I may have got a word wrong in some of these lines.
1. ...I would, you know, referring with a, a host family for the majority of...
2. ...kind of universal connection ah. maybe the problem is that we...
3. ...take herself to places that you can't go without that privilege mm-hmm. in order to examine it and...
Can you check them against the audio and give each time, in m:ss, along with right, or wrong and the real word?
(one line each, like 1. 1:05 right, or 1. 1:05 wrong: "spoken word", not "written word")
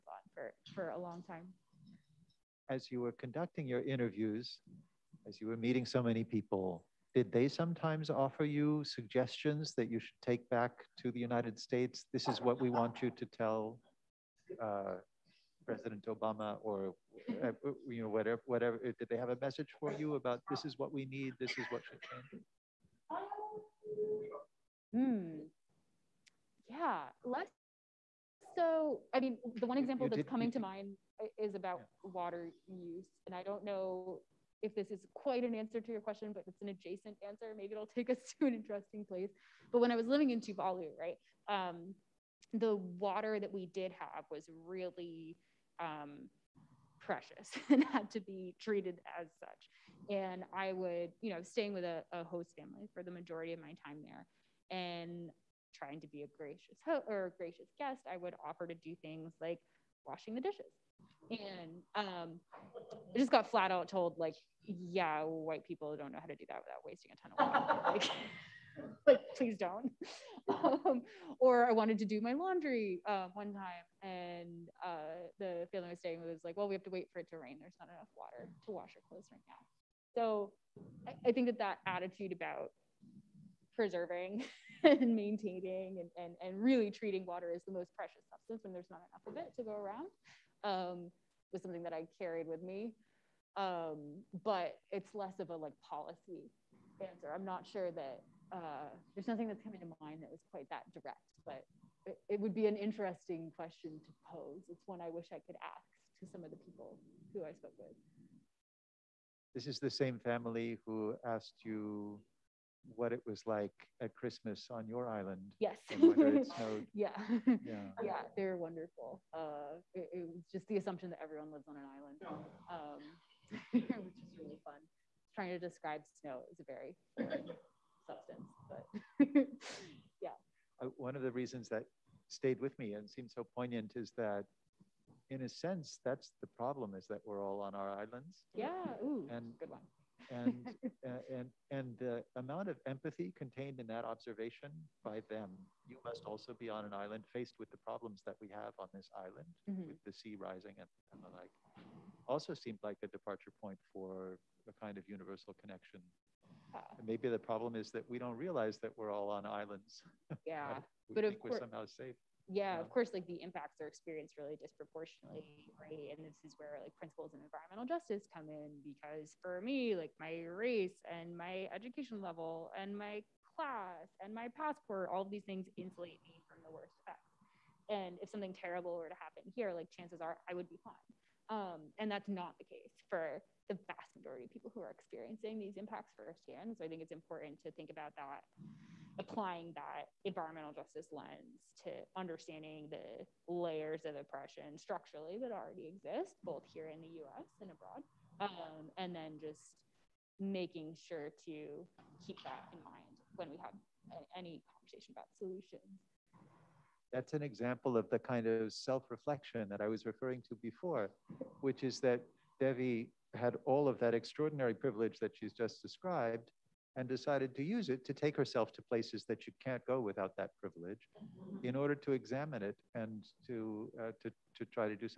1. 0:50 wrong: "staying", not "referring"
2. 2:34 right
3. 3:38 right.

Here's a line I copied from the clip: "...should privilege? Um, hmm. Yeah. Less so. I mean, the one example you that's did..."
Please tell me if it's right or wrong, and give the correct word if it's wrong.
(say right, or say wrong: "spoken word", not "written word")
wrong: "change", not "privilege".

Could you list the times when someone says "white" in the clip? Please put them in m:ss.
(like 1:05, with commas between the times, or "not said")
1:05.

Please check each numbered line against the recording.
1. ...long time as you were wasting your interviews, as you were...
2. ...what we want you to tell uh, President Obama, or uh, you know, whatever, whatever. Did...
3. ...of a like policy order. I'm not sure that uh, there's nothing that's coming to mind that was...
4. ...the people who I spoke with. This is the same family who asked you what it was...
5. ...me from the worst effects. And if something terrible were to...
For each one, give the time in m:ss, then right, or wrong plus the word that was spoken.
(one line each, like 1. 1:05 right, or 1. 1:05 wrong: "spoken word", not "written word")
1. 0:00 wrong: "conducting", not "wasting"
2. 0:12 right
3. 1:35 wrong: "answer", not "order"
4. 1:46 right
5. 2:56 right.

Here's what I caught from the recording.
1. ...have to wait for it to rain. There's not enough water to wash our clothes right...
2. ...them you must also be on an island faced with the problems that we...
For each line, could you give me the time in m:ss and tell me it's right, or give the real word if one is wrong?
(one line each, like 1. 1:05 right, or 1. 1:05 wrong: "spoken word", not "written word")
1. 1:16 right
2. 2:25 right.